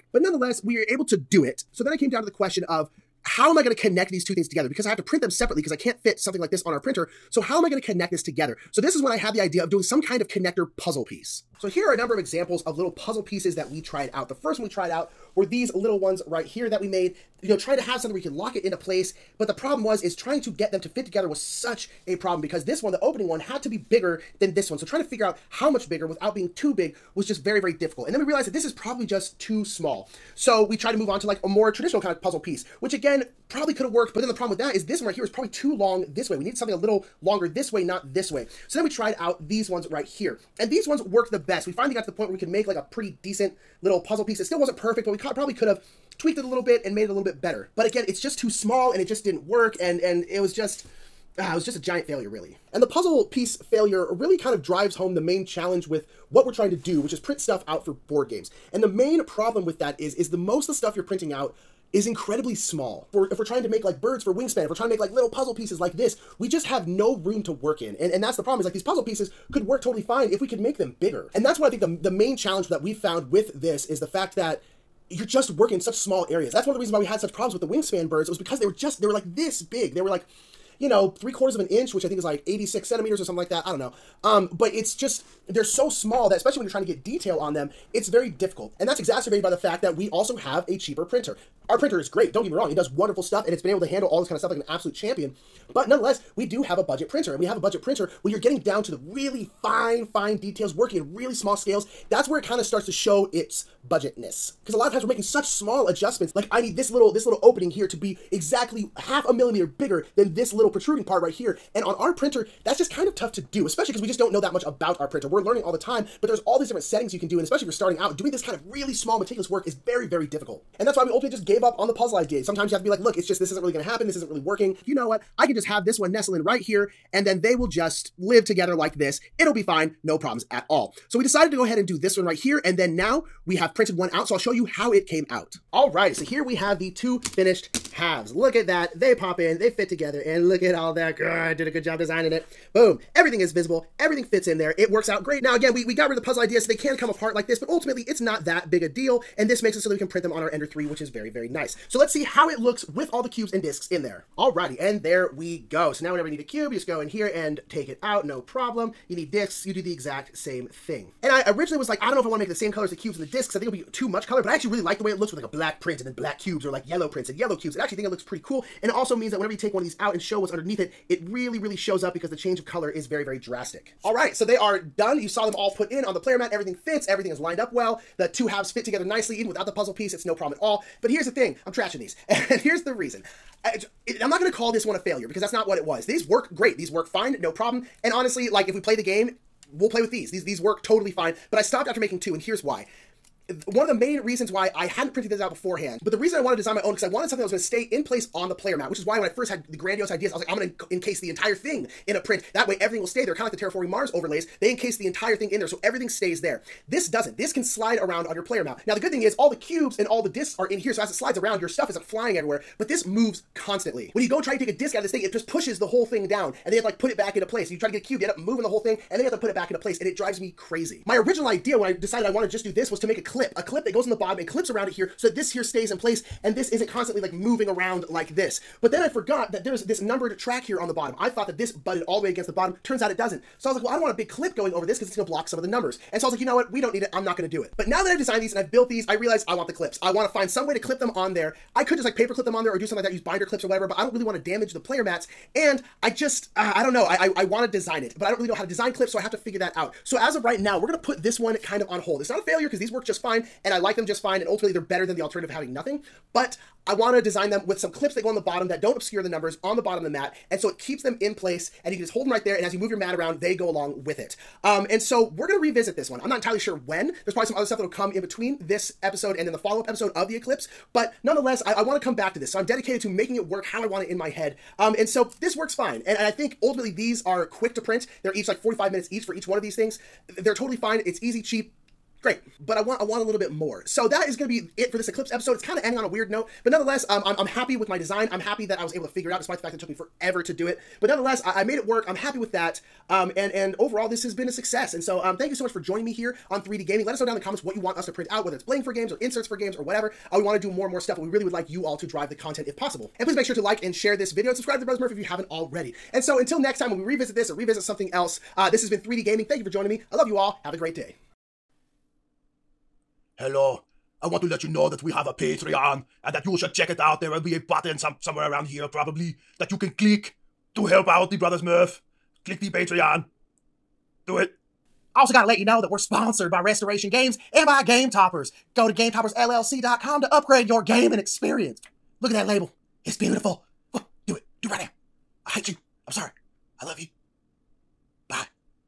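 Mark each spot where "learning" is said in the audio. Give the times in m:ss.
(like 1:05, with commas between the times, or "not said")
1:55.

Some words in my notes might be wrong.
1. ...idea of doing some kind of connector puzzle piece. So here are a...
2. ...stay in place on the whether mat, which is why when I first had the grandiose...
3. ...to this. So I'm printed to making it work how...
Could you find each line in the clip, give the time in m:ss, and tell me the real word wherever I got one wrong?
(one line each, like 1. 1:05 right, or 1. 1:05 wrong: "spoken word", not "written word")
1. 0:09 right
2. 3:17 wrong: "player", not "whether"
3. 4:32 wrong: "dedicated", not "printed".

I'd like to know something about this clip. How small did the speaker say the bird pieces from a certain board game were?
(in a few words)
3/4 of an inch.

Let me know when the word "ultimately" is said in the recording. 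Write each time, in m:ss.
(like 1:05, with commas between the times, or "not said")
2:01, 2:27, 4:14, 4:36.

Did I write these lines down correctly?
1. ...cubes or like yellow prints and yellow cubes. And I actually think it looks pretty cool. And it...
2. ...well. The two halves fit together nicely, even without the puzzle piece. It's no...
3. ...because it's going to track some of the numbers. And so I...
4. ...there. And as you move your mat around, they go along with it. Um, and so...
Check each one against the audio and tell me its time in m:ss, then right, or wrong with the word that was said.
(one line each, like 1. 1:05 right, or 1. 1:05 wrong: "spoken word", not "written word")
1. 2:46 right
2. 2:57 right
3. 3:54 wrong: "block", not "track"
4. 4:22 right.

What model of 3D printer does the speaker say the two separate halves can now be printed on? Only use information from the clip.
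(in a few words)
Ender 3.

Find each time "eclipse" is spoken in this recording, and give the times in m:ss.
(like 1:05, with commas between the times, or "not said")
4:30, 4:45.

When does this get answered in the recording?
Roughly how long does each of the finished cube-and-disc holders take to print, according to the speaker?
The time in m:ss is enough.
4:38.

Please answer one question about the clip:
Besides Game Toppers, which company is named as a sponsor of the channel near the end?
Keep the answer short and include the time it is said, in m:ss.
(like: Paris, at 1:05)
Restoration Games, at 5:26.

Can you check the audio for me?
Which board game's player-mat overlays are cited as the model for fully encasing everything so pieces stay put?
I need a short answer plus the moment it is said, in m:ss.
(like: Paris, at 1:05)
Terraforming Mars, at 3:23.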